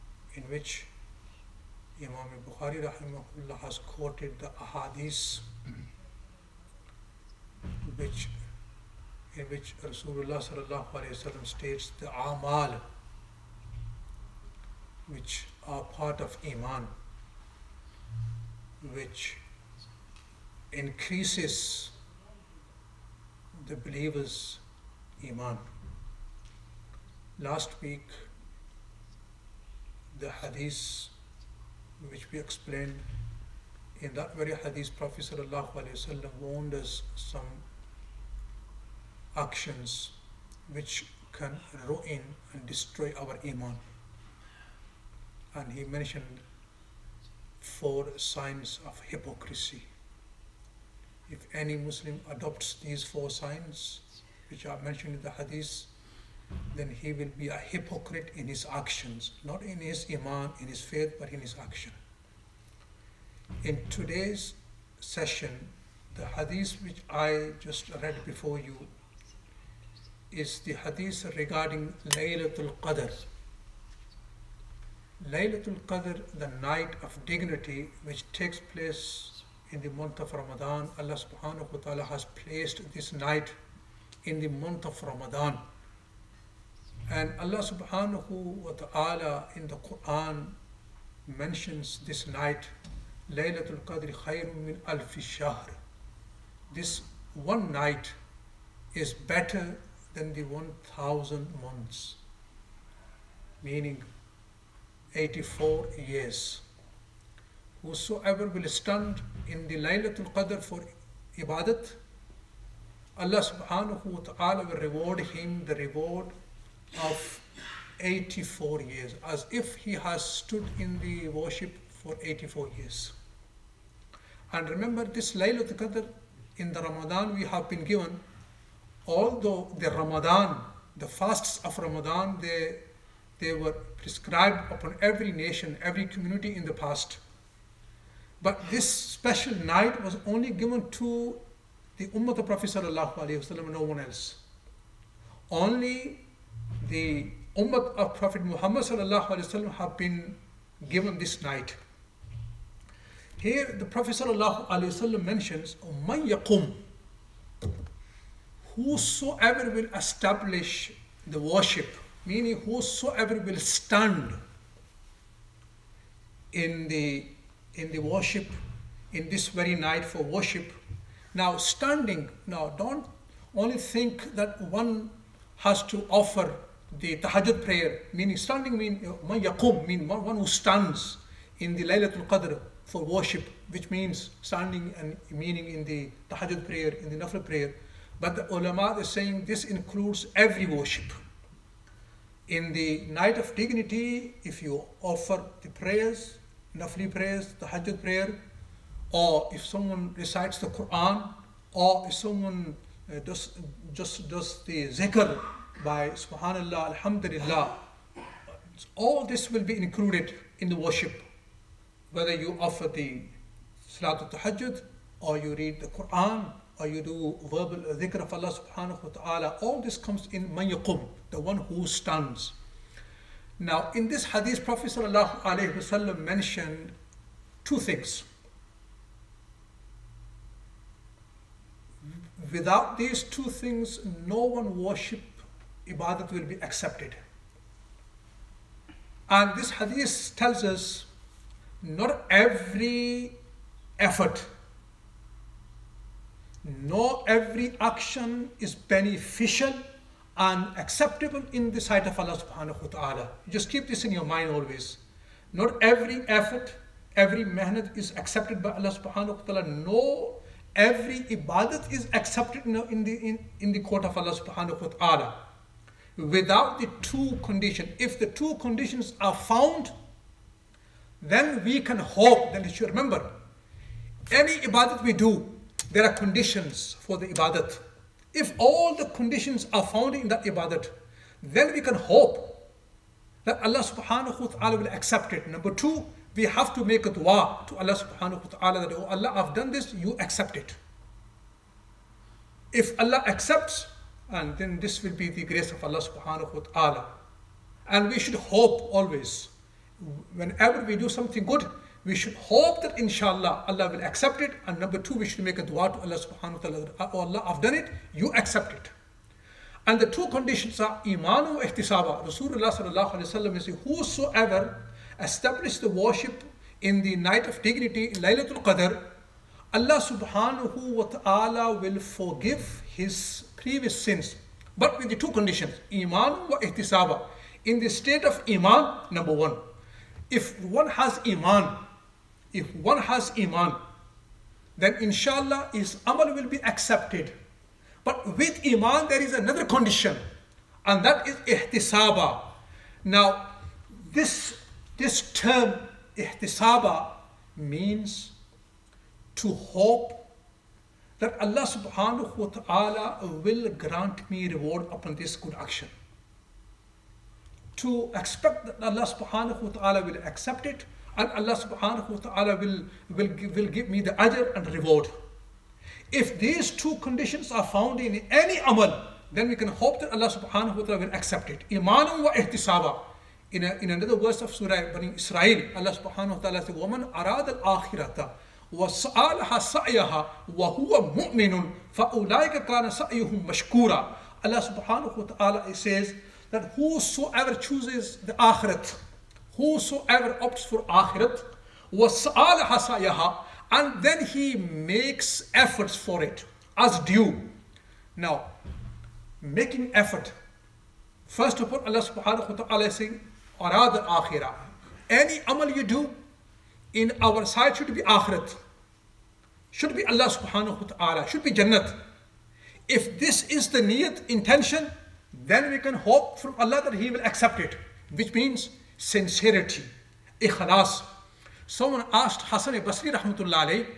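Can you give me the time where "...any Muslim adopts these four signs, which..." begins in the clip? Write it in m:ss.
0:51.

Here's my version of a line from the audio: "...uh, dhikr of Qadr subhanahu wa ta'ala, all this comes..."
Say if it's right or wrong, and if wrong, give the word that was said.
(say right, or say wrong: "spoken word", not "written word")
wrong: "Allah", not "Qadr".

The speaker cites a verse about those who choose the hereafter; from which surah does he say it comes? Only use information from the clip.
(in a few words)
Surah Bani Israel.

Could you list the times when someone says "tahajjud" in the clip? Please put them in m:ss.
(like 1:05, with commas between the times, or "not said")
2:57, 3:06, 3:34.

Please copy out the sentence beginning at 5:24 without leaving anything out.
But with the two conditions, iman wa ihtisaba.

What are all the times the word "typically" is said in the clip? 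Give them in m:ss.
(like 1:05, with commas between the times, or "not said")
not said.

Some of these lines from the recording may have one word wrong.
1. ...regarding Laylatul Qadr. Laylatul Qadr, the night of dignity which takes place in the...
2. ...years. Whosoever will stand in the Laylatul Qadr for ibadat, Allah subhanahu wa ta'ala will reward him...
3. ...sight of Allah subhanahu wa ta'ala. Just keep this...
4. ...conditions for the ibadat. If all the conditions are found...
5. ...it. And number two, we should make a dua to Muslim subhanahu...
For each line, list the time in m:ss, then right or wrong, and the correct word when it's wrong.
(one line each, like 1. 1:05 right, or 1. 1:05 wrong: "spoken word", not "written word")
1. 1:11 right
2. 1:46 right
3. 4:11 right
4. 4:36 right
5. 5:04 wrong: "Allah", not "Muslim".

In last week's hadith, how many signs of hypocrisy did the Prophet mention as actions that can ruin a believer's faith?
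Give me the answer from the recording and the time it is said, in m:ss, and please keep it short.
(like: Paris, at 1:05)
4, at 0:47.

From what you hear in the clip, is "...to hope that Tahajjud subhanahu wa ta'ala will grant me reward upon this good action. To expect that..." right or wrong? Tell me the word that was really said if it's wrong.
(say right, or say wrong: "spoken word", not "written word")
wrong: "Allah", not "Tahajjud".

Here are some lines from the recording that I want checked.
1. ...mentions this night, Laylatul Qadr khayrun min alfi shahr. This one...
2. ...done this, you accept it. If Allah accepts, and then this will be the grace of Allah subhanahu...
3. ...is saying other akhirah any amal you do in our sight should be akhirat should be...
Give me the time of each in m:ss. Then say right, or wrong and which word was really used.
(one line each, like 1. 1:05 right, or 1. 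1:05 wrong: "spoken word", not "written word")
1. 1:31 right
2. 4:49 right
3. 6:42 right.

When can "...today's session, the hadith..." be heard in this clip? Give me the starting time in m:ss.
1:03.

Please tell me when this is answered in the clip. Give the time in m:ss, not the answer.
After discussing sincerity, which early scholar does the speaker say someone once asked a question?
7:02.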